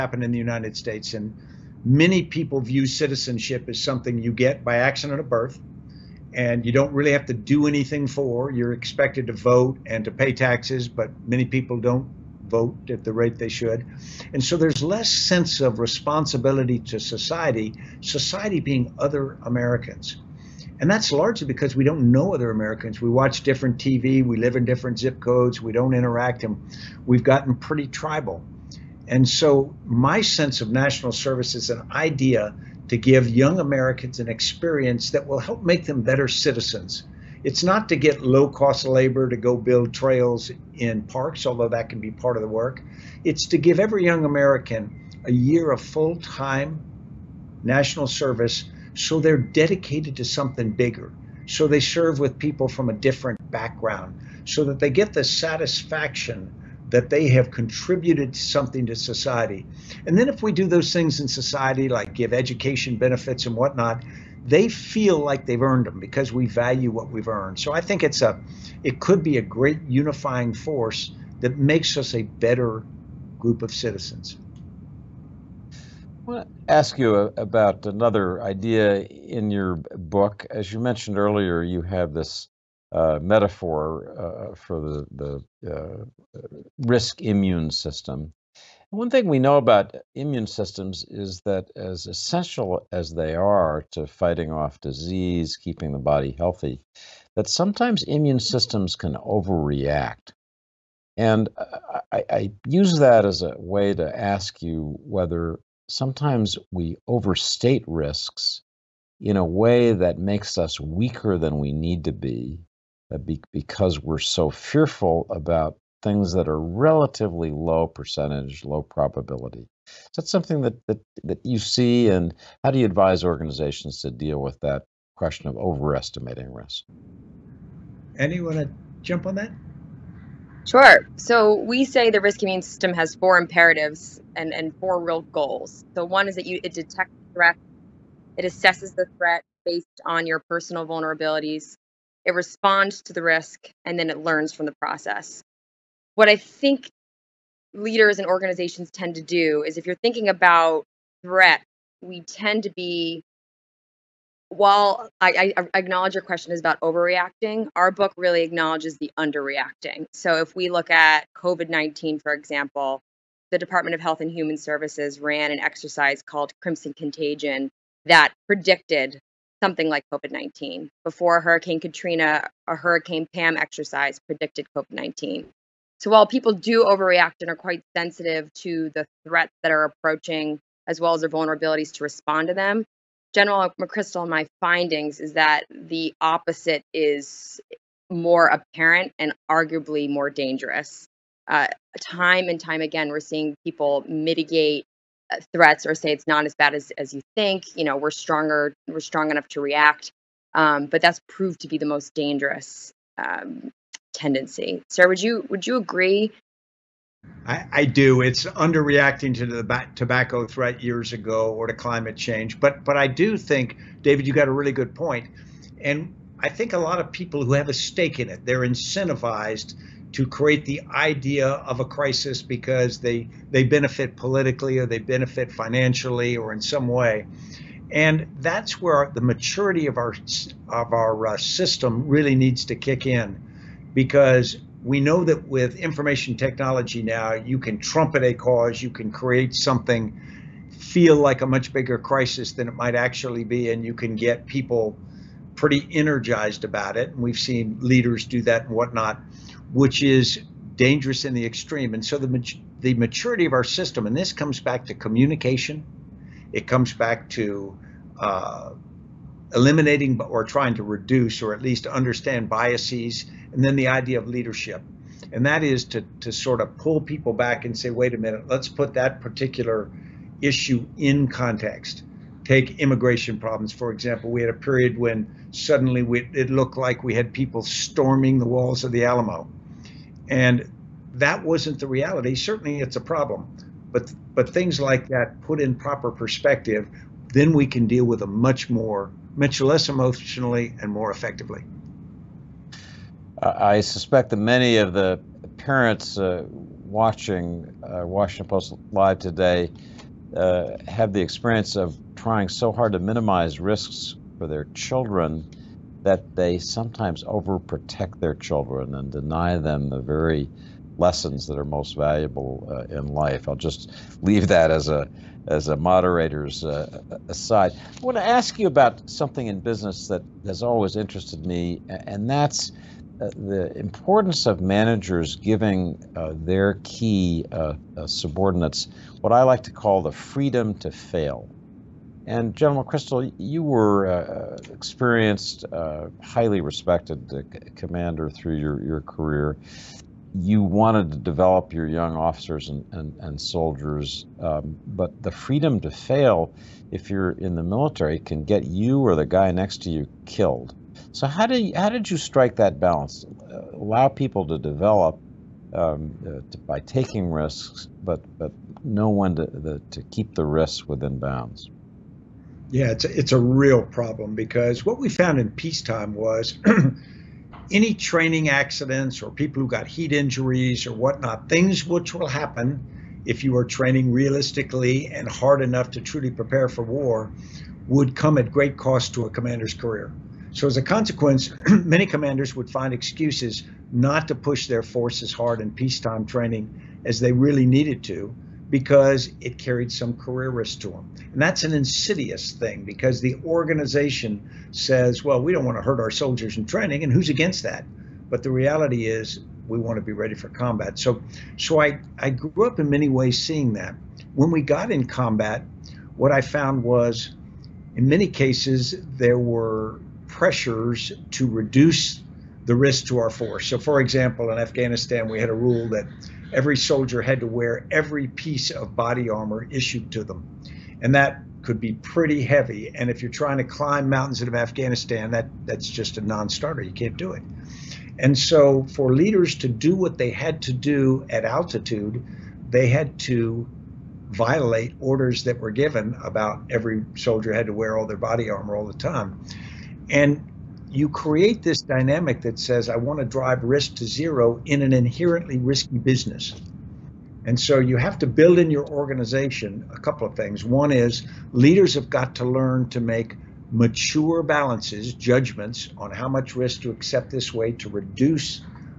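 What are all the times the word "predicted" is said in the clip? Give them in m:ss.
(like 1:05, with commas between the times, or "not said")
2:48, 2:54.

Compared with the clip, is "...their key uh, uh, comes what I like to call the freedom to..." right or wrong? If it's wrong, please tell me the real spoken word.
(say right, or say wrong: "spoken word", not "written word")
wrong: "subordinates", not "comes".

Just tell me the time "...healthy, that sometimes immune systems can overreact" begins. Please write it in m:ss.
1:36.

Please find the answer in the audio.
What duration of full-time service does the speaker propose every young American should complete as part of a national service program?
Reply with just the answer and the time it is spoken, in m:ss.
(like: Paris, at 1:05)
A year, at 0:45.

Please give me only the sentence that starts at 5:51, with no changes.
So how did you, how did you strike that balance?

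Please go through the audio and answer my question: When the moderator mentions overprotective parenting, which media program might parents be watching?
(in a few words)
Washington Post Live.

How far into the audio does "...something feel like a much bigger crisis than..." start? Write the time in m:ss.
3:59.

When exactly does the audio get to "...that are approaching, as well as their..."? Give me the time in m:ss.
2:59.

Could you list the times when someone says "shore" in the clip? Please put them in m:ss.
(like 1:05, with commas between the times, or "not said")
not said.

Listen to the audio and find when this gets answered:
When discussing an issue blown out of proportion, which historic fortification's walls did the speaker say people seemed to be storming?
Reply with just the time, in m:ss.
4:38.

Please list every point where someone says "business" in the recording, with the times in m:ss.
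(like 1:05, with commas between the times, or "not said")
5:19, 7:25.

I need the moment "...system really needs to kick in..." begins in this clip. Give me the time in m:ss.
3:51.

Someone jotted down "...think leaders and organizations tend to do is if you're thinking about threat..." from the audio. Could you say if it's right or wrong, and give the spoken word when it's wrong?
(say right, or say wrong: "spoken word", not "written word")
right.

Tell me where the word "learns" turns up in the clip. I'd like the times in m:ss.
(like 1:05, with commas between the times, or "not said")
2:24, 7:32.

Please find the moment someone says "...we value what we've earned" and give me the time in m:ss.
1:06.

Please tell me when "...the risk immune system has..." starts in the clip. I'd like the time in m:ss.
2:12.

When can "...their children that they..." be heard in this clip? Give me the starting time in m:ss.
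5:04.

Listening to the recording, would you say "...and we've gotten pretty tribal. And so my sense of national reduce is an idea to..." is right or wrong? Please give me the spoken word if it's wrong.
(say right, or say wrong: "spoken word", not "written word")
wrong: "service", not "reduce".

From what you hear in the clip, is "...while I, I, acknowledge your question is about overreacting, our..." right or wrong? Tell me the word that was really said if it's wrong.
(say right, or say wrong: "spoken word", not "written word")
right.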